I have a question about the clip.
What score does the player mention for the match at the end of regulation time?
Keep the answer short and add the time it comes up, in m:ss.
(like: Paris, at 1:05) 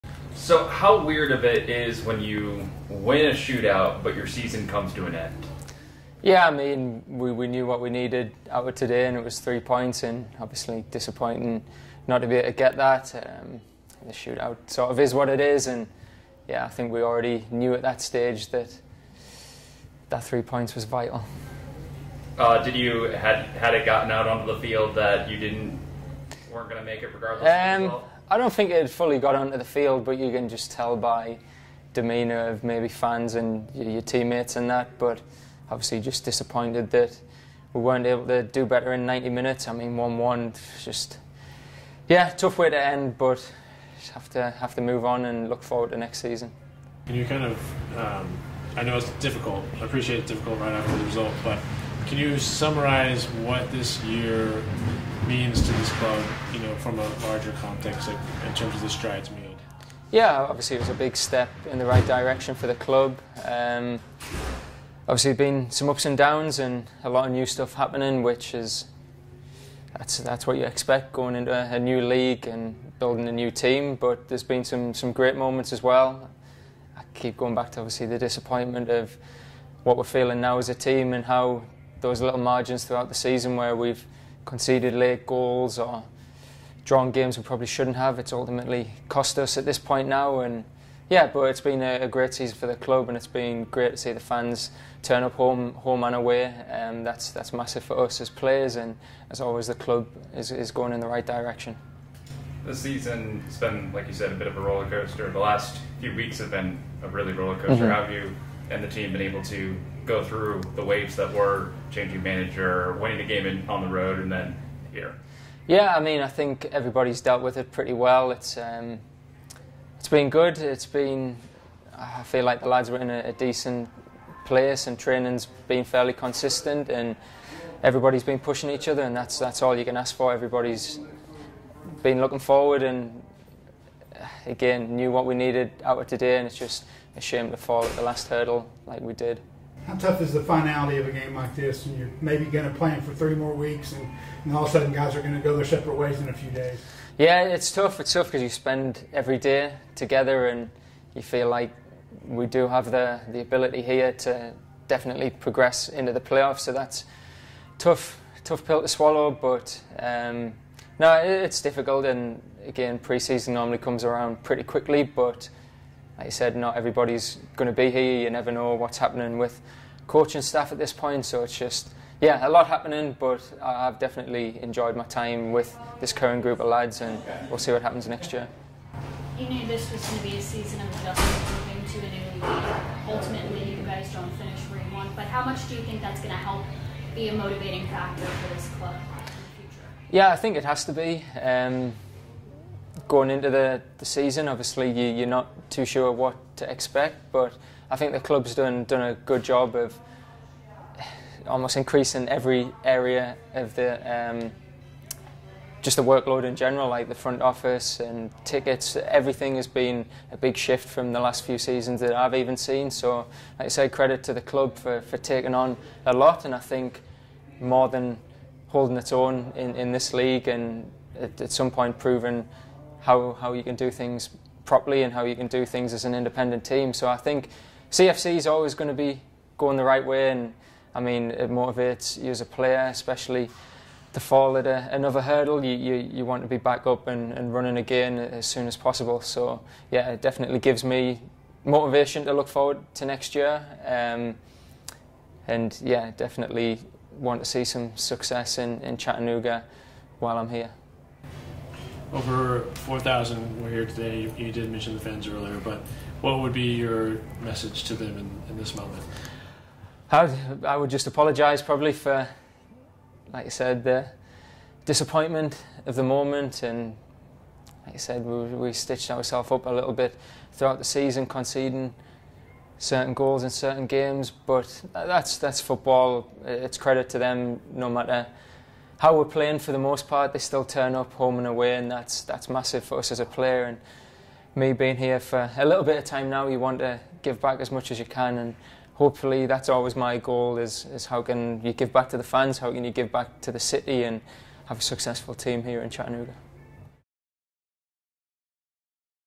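1-1, at 0:39.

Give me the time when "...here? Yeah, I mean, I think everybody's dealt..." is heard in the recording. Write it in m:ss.
1:54.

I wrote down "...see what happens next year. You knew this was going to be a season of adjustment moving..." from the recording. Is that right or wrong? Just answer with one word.
right.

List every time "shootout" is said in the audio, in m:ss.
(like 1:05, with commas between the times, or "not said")
0:03, 0:14.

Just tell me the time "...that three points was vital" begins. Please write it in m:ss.
0:20.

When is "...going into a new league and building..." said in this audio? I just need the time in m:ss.
1:11.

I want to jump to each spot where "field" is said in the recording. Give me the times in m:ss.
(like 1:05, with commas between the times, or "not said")
0:24, 0:29.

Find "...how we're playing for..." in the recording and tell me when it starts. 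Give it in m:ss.
4:39.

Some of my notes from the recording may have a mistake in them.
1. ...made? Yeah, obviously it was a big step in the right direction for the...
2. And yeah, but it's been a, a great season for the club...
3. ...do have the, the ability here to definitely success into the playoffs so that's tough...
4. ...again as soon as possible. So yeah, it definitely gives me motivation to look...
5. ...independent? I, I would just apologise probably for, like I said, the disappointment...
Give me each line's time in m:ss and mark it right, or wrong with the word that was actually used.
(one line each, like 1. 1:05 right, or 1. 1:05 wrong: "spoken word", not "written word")
1. 0:59 right
2. 1:30 right
3. 2:32 wrong: "progress", not "success"
4. 3:57 right
5. 4:18 wrong: "moment", not "independent".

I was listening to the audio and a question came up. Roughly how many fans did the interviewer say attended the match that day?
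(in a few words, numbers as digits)
over 4,000.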